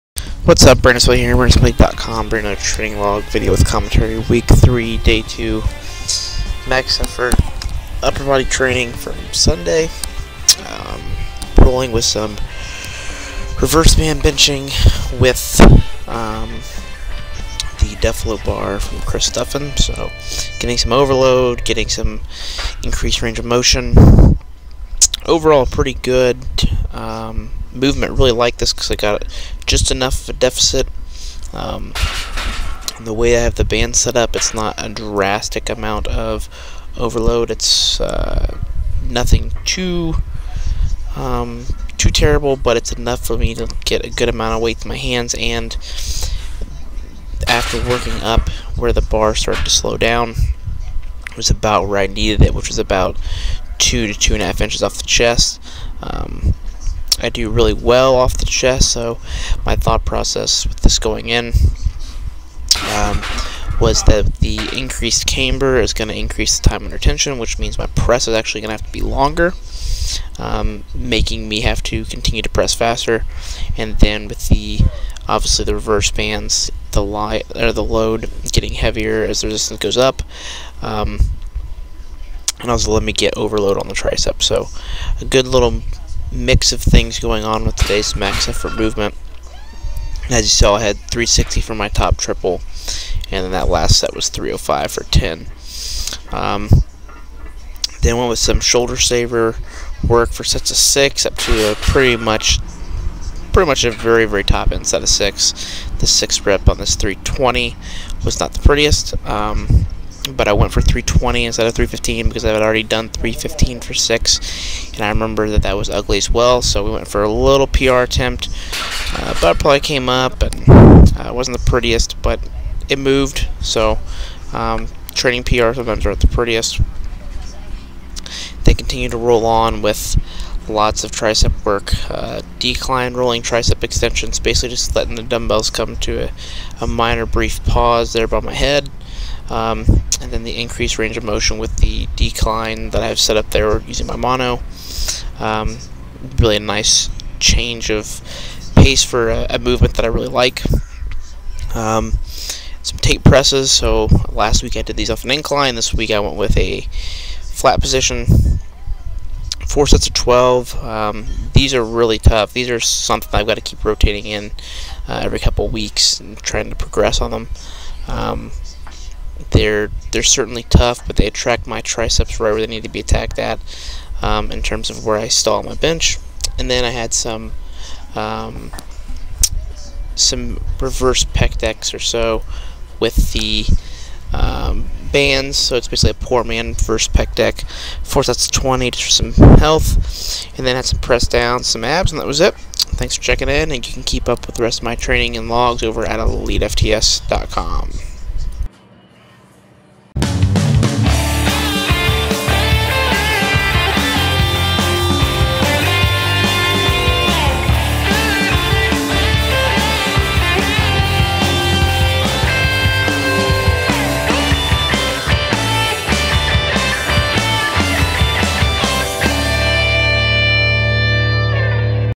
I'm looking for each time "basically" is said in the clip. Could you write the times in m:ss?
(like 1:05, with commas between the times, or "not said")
2:14, 3:05.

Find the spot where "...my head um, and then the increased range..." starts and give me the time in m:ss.
2:18.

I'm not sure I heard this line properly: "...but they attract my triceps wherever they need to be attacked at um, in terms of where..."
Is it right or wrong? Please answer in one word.
right.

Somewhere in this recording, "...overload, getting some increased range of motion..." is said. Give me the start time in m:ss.
0:20.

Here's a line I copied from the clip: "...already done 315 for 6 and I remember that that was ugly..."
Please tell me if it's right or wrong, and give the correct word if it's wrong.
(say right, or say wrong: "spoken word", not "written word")
right.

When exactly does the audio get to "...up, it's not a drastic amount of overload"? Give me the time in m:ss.
0:34.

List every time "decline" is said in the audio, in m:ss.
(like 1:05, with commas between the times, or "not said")
2:12, 2:22.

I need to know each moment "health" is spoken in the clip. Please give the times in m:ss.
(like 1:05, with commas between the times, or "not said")
3:09.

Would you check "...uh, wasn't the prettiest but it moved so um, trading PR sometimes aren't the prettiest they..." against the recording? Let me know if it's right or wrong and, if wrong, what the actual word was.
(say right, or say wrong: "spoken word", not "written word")
right.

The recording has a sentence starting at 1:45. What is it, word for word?
The sixth rep on this 320 was not the prettiest.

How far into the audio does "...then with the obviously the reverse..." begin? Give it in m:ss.
1:13.